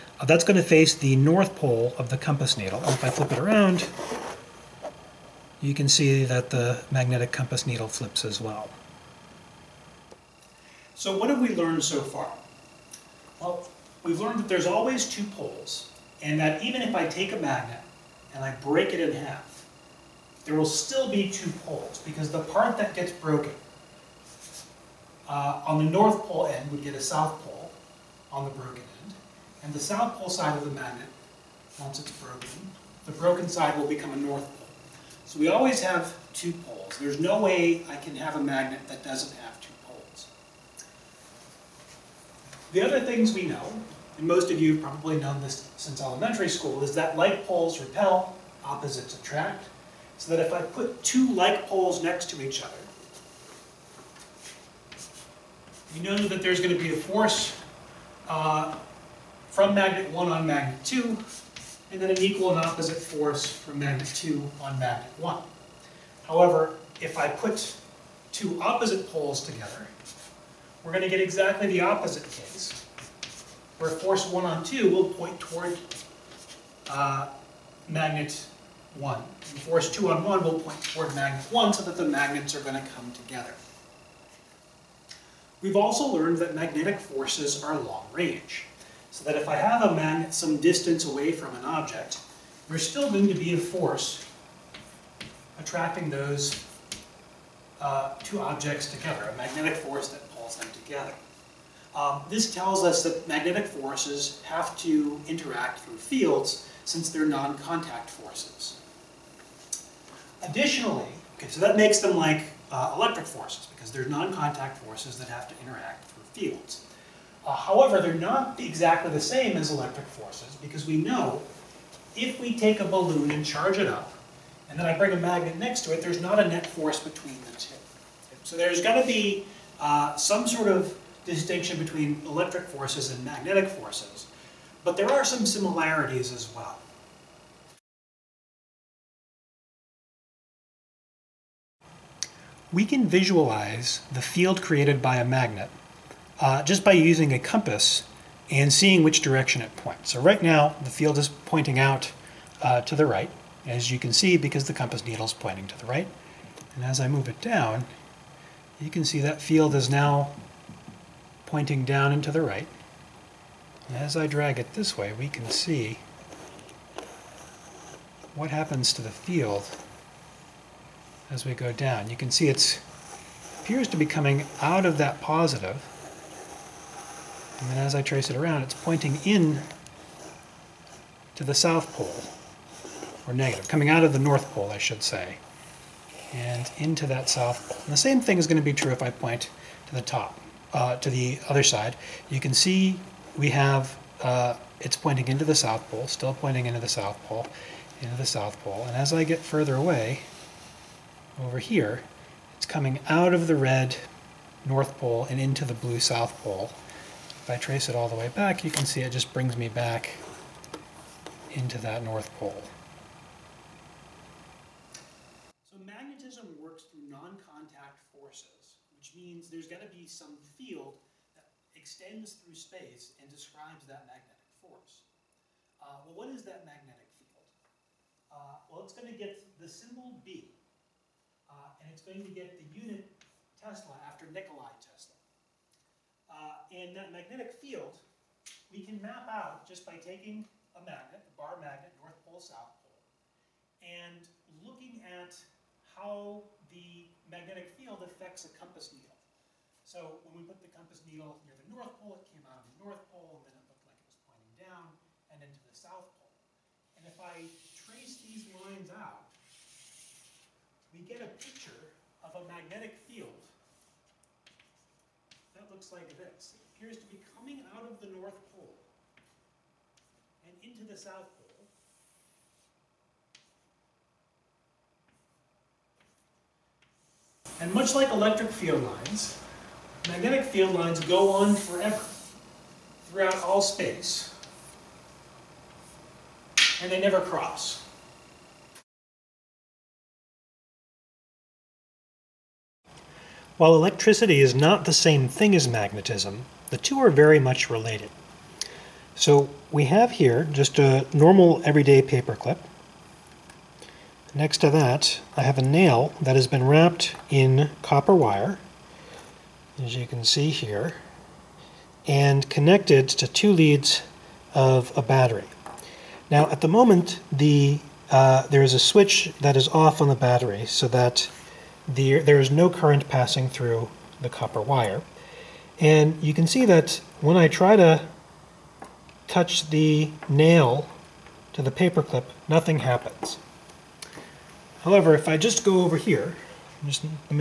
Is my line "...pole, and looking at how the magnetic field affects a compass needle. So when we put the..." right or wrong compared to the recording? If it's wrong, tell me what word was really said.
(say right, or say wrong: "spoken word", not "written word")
right.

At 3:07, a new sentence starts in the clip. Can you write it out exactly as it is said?
And the same thing is going to be true if I point to the top, uh, to the other side.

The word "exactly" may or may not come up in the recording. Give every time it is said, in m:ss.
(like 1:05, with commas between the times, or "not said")
1:11, 1:58.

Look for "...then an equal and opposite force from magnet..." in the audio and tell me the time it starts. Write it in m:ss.
1:02.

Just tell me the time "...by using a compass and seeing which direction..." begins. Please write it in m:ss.
2:26.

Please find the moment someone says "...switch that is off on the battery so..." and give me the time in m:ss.
5:18.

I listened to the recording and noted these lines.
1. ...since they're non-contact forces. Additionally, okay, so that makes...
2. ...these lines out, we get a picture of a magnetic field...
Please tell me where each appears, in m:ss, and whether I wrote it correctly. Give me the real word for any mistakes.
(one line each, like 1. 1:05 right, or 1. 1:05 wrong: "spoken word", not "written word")
1. 1:46 right
2. 4:18 right.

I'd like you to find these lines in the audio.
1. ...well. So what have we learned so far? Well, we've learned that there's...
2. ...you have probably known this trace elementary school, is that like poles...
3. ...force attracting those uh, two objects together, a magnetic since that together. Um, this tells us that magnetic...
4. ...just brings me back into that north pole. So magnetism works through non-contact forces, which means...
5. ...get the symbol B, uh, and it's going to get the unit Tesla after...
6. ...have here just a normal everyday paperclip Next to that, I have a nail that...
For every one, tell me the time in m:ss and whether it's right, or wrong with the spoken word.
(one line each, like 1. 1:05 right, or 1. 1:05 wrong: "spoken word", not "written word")
1. 0:08 right
2. 0:44 wrong: "since", not "trace"
3. 1:33 wrong: "force", not "since"
4. 3:29 right
5. 3:49 right
6. 4:59 right.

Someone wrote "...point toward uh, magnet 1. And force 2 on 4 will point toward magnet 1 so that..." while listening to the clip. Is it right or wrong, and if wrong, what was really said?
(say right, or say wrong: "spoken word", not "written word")
wrong: "1", not "4".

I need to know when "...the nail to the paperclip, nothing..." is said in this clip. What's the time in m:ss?
5:29.